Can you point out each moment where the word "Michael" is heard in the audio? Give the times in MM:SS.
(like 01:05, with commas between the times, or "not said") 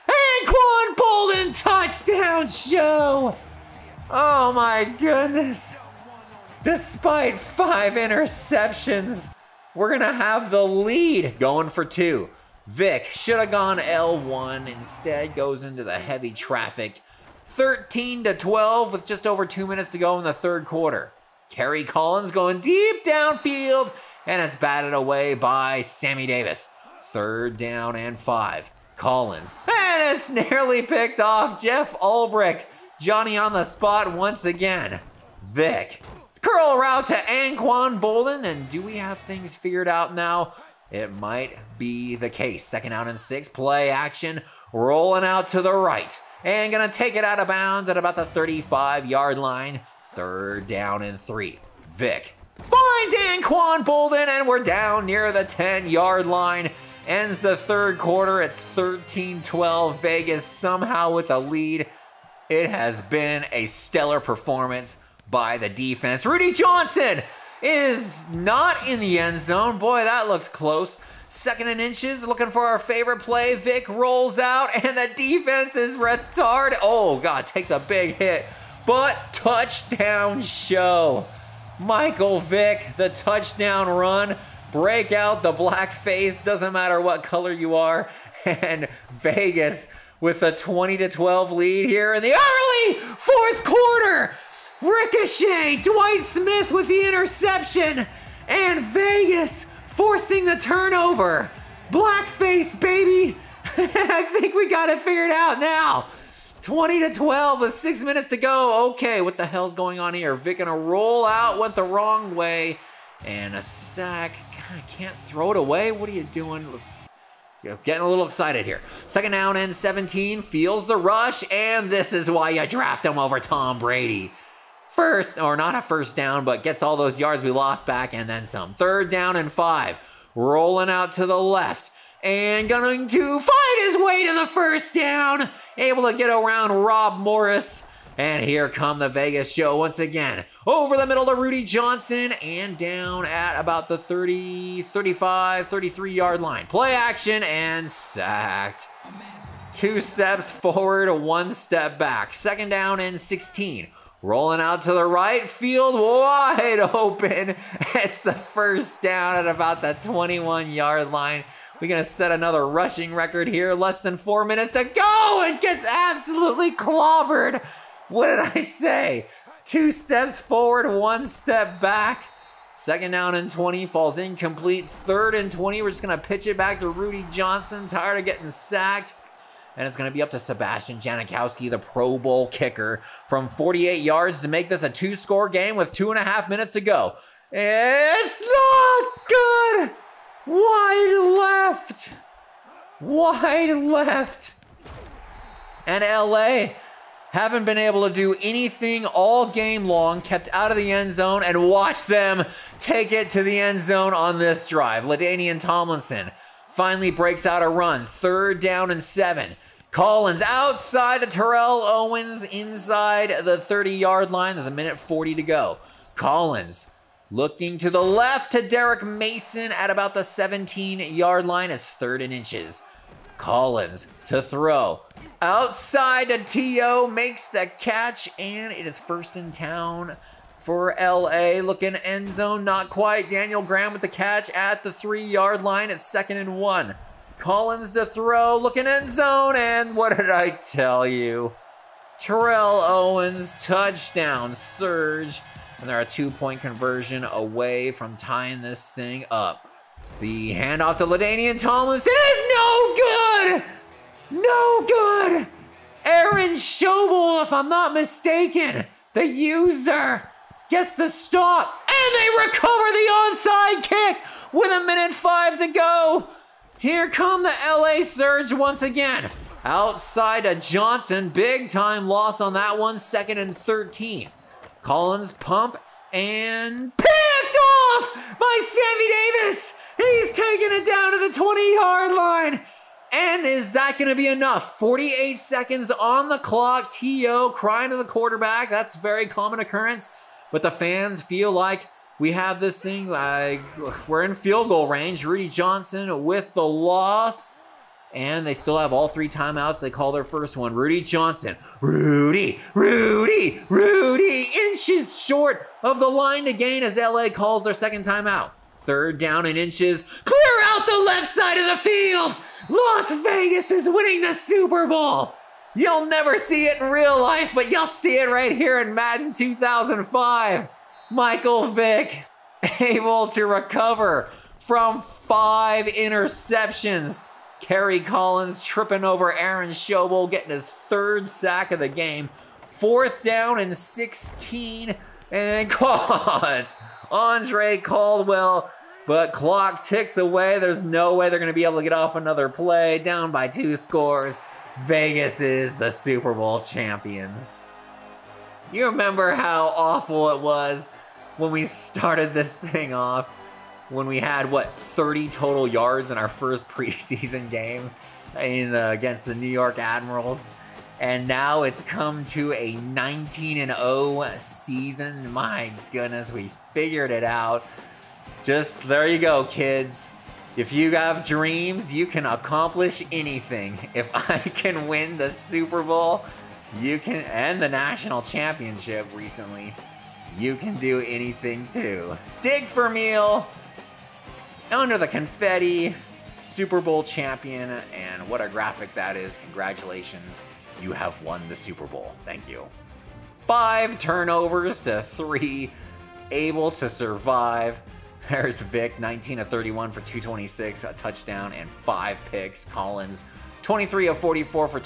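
01:21, 05:21.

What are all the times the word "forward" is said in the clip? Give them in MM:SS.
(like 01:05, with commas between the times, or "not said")
02:30, 02:50.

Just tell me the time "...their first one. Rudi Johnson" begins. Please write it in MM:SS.
05:00.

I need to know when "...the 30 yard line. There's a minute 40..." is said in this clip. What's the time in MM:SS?
03:33.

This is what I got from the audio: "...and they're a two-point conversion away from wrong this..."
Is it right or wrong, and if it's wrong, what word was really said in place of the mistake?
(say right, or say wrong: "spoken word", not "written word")
wrong: "tying", not "wrong".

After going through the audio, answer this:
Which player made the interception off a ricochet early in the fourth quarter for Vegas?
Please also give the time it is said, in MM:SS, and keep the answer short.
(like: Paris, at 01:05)
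Dwight Smith, at 01:35.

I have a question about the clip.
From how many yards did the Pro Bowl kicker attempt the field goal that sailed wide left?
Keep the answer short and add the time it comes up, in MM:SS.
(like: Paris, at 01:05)
48, at 03:03.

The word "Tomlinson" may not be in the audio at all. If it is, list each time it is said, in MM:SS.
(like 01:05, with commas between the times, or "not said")
03:25, 04:11.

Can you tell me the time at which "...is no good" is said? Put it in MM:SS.
04:12.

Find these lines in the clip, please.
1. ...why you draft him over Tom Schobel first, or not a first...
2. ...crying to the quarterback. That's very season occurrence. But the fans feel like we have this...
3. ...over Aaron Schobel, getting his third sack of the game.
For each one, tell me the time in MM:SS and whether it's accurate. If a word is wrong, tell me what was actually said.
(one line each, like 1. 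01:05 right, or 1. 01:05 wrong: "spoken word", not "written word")
1. 02:02 wrong: "Brady", not "Schobel"
2. 04:47 wrong: "common", not "season"
3. 05:29 right.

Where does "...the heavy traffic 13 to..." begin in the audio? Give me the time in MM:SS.
00:15.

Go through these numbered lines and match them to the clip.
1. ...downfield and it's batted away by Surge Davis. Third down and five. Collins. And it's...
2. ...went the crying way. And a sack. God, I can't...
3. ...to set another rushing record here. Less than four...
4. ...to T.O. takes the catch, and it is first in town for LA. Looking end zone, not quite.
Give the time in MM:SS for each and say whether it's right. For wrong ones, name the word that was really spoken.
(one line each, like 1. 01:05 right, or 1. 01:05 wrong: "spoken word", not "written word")
1. 00:23 wrong: "Sammy", not "Surge"
2. 01:51 wrong: "wrong", not "crying"
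3. 02:42 right
4. 03:46 wrong: "makes", not "takes".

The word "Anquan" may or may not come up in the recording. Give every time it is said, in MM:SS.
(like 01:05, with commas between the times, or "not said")
00:00, 00:37, 00:53.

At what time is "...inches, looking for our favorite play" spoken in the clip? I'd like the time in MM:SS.
01:11.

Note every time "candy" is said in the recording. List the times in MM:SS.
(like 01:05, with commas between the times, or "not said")
not said.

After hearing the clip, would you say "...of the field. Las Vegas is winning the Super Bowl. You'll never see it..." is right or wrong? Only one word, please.
right.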